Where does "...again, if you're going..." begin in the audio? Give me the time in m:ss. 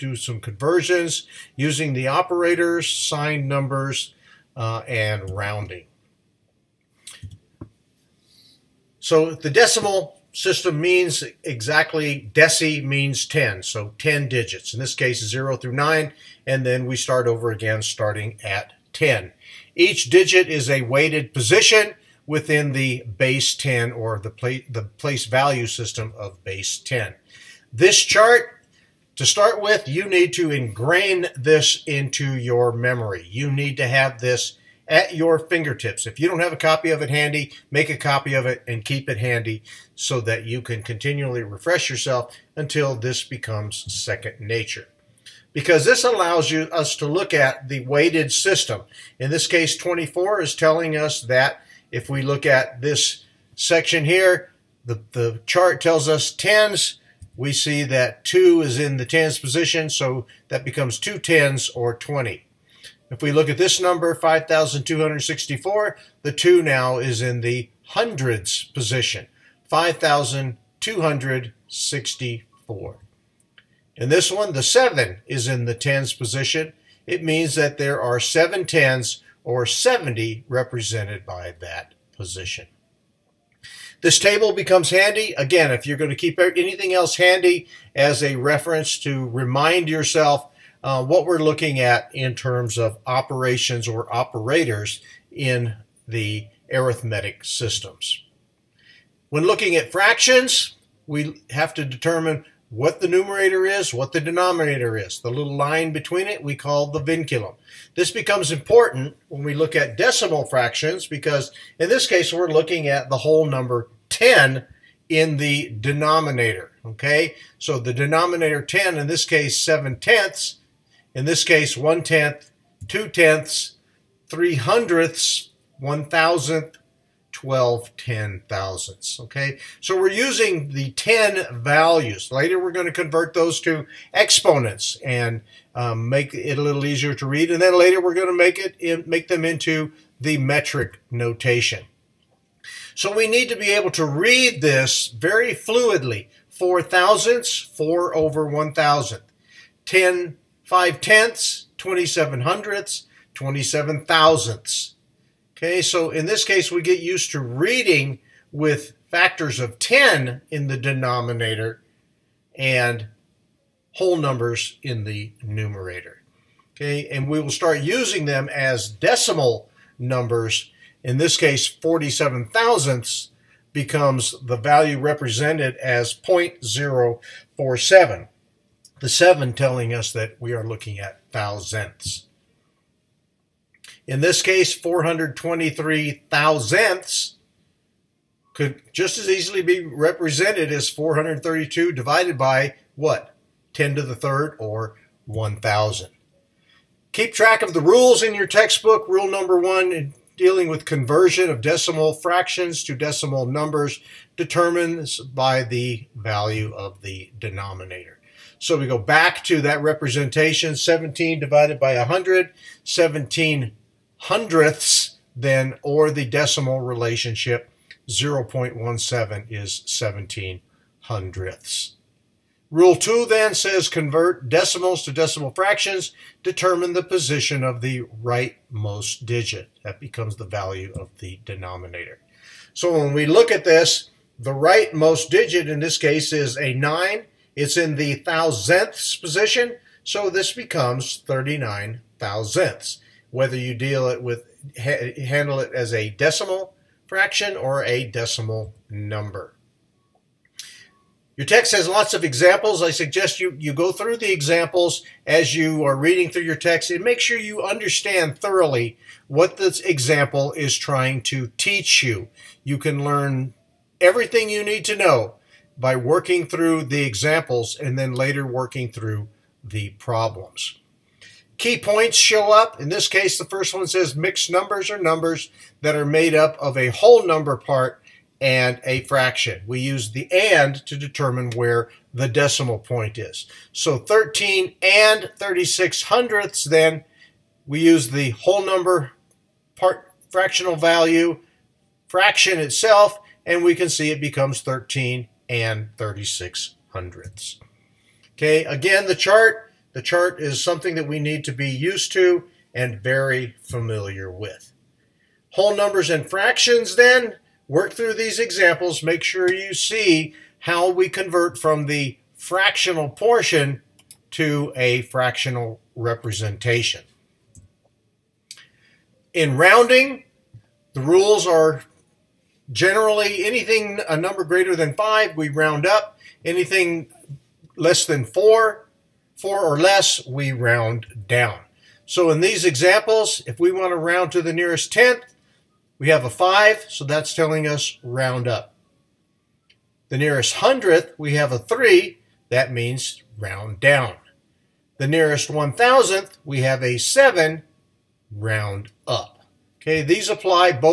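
1:25.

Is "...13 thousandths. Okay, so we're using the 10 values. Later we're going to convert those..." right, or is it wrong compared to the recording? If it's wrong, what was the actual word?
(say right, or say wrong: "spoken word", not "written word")
wrong: "10", not "13".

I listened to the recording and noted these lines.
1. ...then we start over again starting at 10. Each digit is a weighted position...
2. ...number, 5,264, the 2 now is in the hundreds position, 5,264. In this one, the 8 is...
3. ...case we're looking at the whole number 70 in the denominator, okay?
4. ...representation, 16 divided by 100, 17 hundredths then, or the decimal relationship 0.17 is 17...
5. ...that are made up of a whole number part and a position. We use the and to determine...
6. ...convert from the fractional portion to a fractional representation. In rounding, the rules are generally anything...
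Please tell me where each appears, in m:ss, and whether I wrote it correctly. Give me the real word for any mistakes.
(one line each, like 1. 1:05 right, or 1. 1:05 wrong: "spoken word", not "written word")
1. 0:16 right
2. 1:03 wrong: "7", not "8"
3. 1:52 wrong: "10", not "70"
4. 3:29 wrong: "17", not "16"
5. 4:35 wrong: "fraction", not "position"
6. 5:11 right.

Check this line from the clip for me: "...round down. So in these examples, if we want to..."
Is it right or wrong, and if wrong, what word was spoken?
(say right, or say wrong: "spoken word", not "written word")
right.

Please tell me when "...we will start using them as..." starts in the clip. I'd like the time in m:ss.
2:47.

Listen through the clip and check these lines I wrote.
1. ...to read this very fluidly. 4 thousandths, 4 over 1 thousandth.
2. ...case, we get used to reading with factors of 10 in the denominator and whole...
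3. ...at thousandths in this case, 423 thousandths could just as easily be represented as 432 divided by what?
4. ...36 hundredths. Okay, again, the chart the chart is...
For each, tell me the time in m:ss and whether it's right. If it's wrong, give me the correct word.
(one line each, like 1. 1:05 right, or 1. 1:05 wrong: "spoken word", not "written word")
1. 2:23 right
2. 2:36 right
3. 3:00 right
4. 4:55 right.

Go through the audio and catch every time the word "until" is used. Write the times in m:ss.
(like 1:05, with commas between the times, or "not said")
0:42.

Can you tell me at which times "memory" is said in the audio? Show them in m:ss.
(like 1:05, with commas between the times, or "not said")
0:32.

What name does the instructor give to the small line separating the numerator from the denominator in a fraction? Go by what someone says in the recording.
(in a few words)
vinculum.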